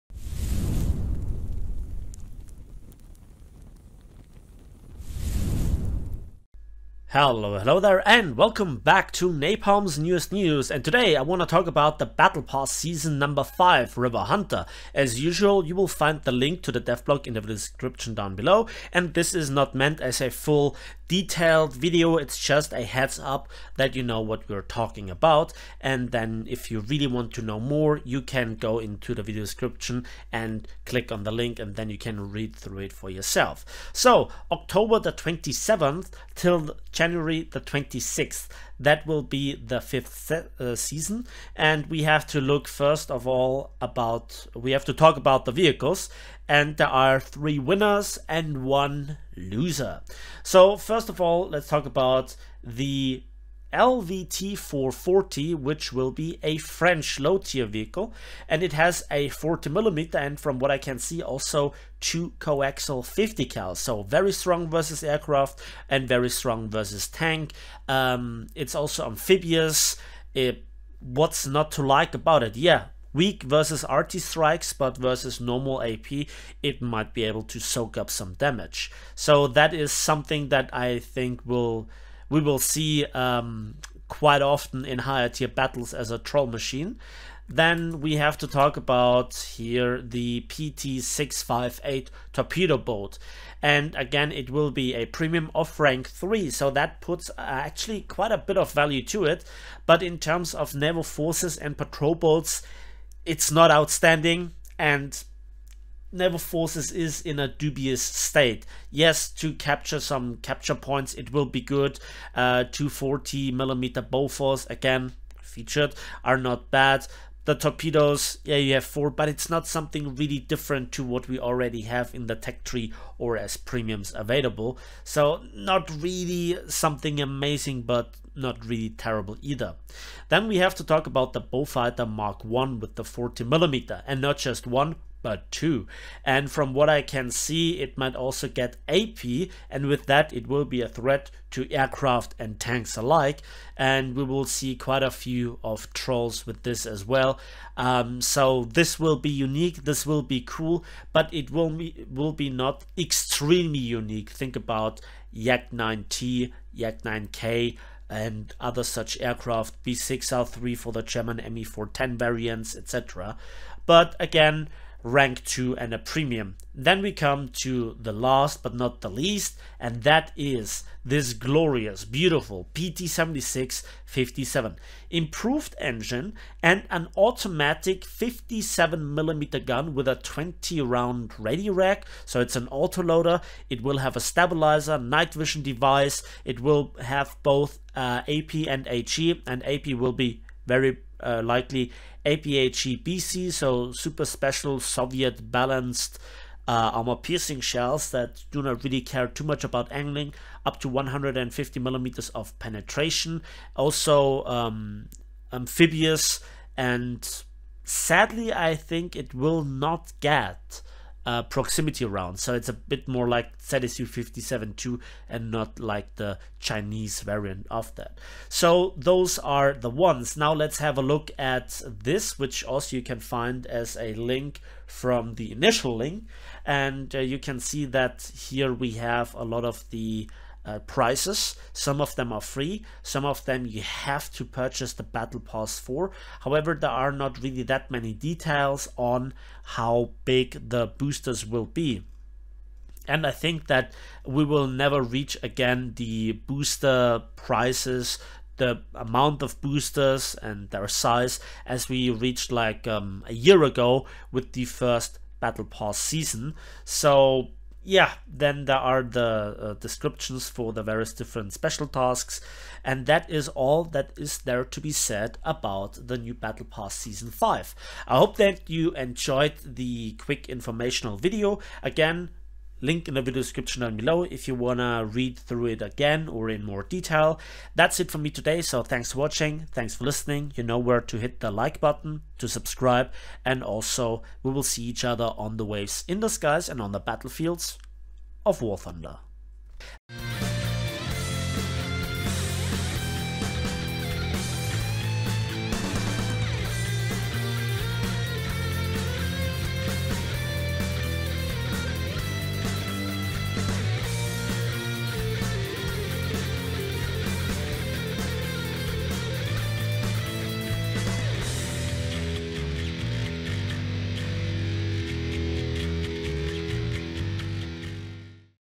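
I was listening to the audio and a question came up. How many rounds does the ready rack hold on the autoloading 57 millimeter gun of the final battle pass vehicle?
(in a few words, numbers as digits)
20.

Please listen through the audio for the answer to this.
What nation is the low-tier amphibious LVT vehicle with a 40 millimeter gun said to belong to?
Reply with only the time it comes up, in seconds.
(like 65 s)
56 s.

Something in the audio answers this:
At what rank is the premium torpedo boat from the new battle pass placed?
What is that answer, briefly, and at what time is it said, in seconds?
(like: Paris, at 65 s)
rank 3, at 95 s.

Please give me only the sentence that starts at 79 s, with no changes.
So that is something that I think will we will see um, quite often in higher tier battles as a troll machine.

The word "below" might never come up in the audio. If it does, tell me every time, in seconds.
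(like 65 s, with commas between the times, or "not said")
18 s, 273 s.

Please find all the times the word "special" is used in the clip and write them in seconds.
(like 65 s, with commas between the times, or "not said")
194 s, 261 s.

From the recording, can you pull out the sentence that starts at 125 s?
So not really something amazing, but not really terrible either.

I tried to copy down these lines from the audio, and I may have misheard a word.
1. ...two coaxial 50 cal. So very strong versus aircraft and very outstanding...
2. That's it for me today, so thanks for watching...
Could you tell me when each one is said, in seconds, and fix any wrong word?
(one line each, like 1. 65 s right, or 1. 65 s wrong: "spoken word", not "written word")
1. 62 s wrong: "strong", not "outstanding"
2. 277 s right.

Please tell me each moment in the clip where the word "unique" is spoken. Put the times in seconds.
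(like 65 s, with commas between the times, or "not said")
149 s, 153 s.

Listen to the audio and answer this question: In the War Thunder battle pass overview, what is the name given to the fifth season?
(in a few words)
River Hunter.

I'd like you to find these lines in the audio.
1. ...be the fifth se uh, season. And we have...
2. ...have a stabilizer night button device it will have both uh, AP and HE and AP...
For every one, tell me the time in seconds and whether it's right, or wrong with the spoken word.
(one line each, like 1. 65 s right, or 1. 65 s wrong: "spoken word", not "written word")
1. 39 s right
2. 183 s wrong: "vision", not "button".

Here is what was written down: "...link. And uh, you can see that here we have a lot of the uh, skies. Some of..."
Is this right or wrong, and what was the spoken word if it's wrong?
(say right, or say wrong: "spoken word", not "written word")
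wrong: "prices", not "skies".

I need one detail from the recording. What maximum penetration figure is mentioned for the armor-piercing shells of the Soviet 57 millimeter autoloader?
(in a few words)
150 millimeters.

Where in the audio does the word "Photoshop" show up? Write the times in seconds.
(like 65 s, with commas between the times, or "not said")
not said.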